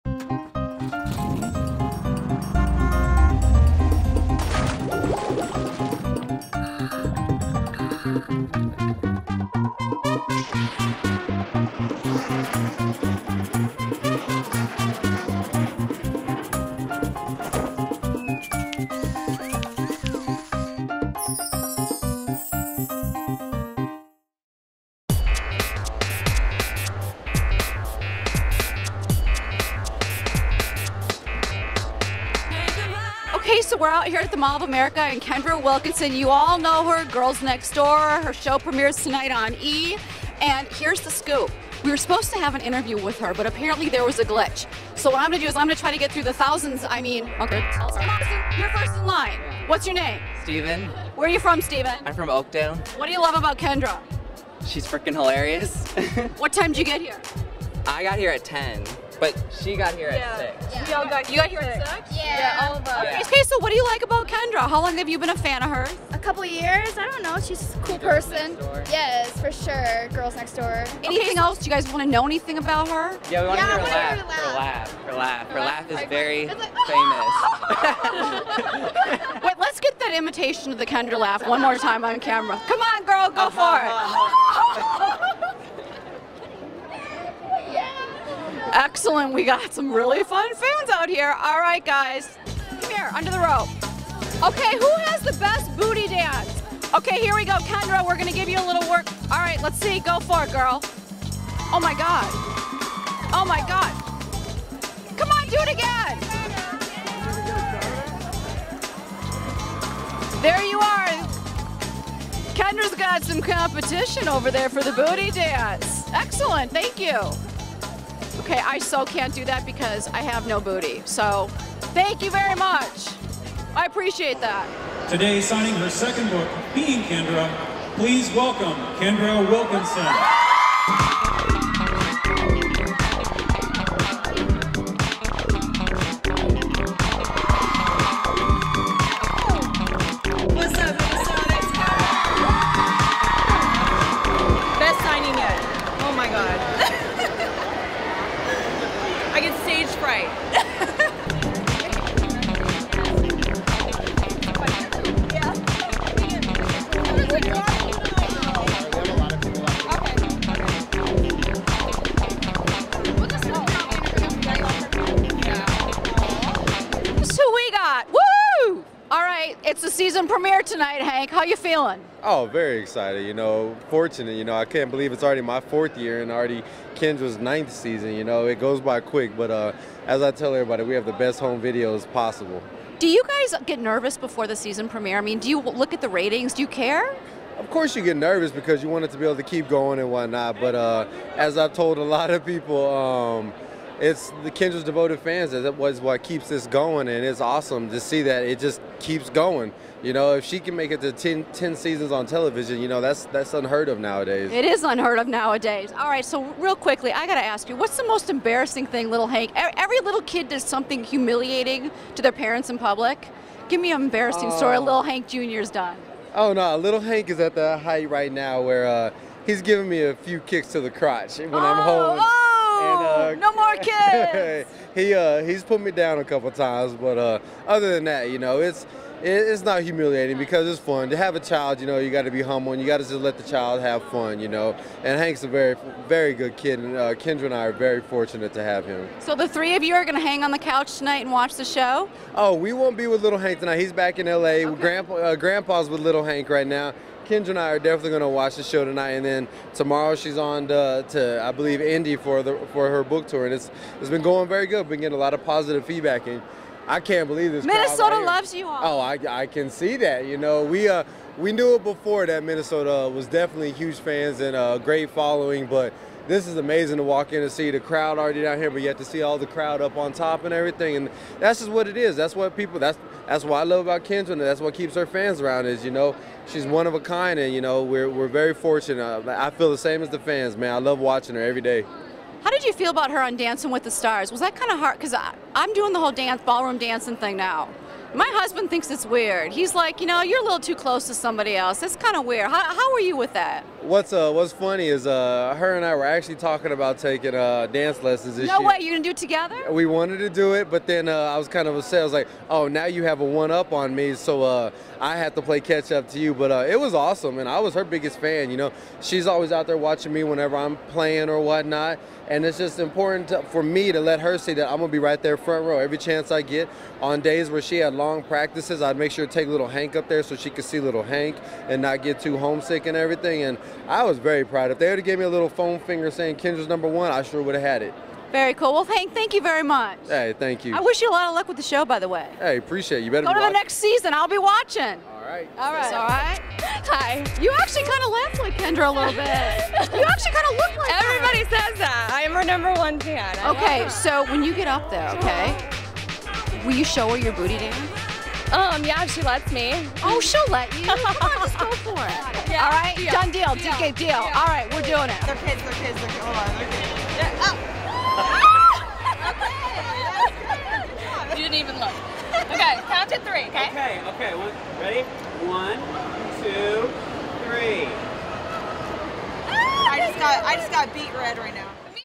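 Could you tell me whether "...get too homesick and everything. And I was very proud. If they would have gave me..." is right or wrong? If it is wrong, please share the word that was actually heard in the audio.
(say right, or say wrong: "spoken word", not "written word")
right.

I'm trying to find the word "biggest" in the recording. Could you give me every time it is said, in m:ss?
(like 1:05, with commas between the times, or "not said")
5:07.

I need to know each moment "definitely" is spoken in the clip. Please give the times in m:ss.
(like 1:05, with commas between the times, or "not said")
4:07, 4:23.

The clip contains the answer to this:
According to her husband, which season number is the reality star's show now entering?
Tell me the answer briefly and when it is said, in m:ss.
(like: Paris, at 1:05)
9th, at 2:57.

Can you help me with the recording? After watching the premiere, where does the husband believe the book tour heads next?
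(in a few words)
Indy.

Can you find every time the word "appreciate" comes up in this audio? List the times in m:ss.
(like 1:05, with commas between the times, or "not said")
2:03, 5:32.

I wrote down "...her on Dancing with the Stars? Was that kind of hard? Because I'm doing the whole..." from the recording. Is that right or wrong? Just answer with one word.
right.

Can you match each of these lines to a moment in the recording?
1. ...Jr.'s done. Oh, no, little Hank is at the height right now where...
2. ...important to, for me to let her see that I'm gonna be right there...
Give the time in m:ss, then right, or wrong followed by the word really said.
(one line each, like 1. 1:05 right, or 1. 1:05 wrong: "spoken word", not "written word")
1. 3:35 right
2. 5:12 right.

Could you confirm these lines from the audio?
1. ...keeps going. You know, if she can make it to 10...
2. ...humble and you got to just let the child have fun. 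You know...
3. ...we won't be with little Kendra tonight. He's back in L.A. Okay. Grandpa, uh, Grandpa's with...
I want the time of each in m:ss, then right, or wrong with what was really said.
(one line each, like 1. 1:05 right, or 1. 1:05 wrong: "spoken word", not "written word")
1. 3:18 right
2. 3:52 right
3. 4:02 wrong: "Hank", not "Kendra".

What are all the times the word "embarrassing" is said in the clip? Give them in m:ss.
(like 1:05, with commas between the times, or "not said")
3:28, 3:34.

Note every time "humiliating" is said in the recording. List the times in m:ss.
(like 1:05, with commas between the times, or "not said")
3:31, 3:49.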